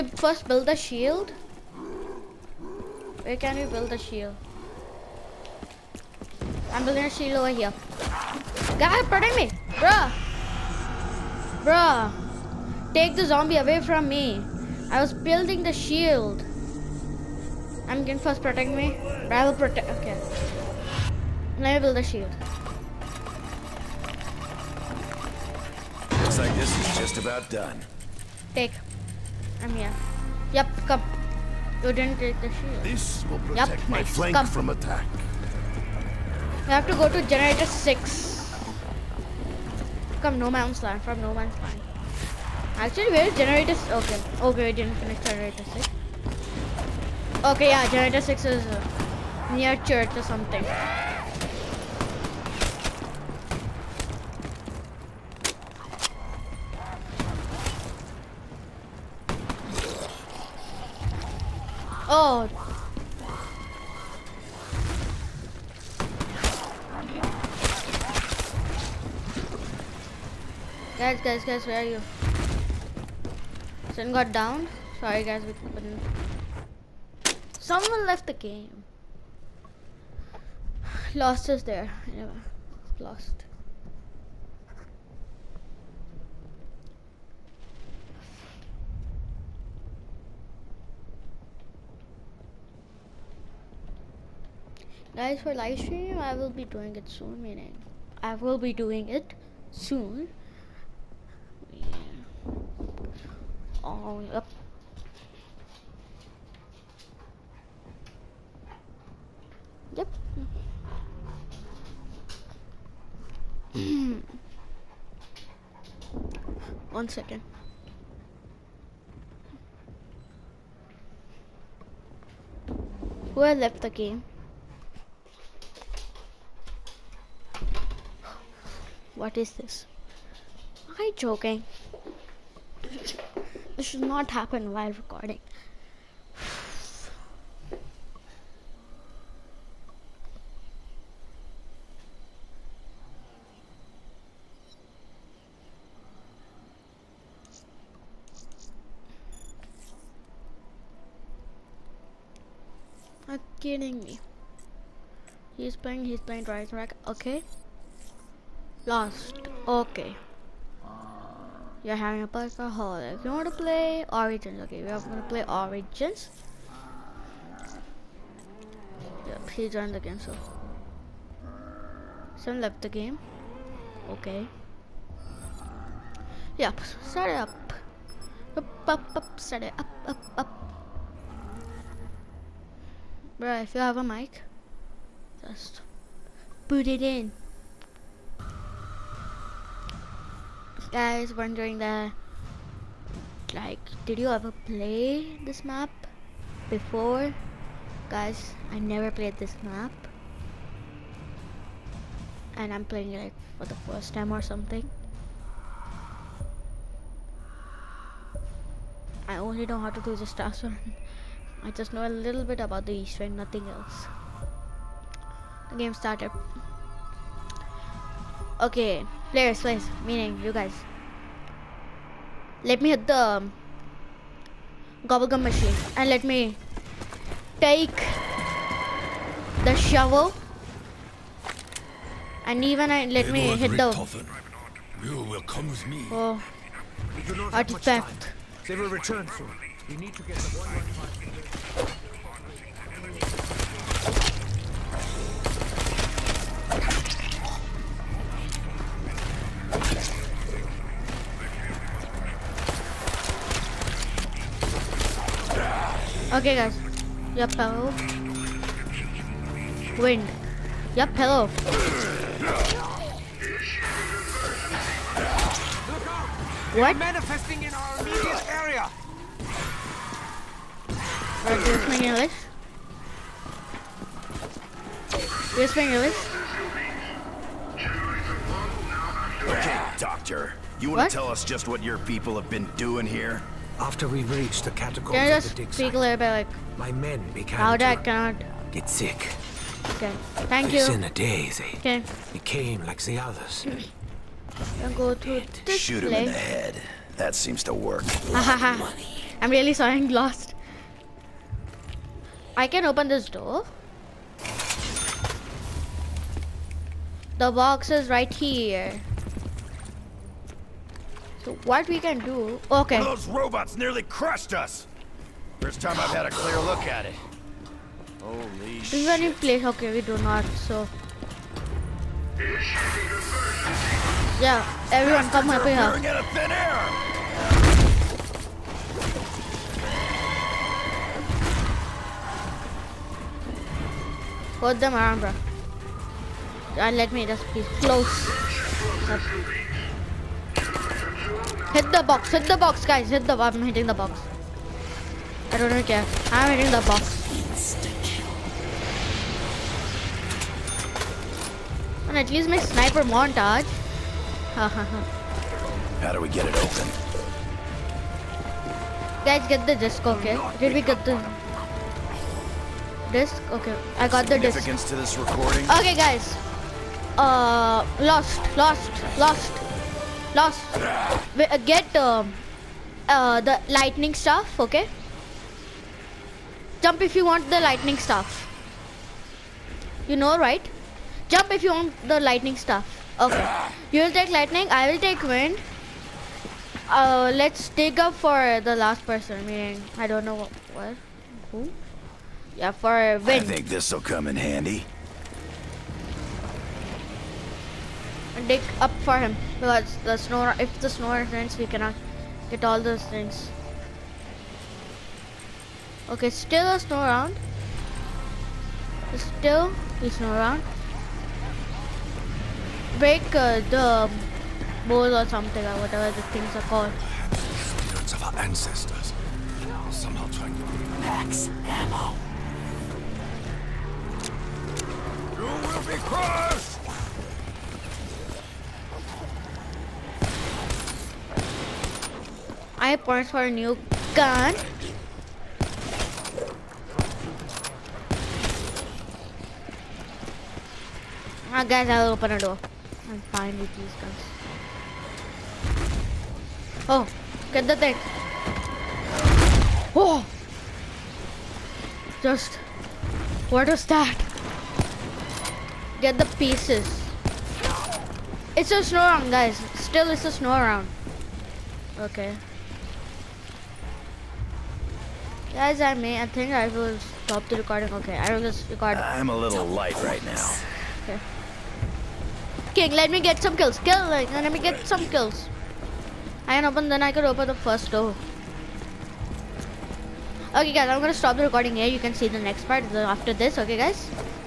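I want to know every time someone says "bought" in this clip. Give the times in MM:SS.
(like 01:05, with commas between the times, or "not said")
07:12.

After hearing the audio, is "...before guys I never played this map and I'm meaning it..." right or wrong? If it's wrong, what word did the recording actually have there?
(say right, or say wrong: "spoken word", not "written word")
wrong: "playing", not "meaning".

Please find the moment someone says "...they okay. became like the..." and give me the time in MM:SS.
04:51.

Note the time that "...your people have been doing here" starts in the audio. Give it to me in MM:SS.
04:41.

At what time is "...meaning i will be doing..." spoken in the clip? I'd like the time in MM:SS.
01:37.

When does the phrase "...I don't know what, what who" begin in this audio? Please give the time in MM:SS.
06:29.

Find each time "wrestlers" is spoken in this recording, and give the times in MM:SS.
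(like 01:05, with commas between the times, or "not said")
not said.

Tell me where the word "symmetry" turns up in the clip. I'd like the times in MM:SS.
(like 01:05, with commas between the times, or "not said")
not said.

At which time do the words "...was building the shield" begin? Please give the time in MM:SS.
00:15.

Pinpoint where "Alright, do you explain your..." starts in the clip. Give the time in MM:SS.
04:31.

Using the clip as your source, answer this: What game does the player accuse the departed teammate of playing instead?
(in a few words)
Dragon's Rack.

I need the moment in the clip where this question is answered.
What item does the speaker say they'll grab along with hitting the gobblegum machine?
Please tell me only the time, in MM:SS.
03:49.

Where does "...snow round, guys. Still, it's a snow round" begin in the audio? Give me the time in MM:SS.
07:38.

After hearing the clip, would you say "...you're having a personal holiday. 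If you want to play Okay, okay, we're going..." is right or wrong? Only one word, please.
wrong.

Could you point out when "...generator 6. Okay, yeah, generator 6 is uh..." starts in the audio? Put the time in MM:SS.
00:45.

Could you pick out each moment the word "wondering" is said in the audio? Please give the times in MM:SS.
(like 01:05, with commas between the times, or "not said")
03:11.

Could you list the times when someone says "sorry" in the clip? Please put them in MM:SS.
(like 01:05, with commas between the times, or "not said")
01:15, 04:59.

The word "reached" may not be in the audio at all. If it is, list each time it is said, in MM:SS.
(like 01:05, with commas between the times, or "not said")
04:44.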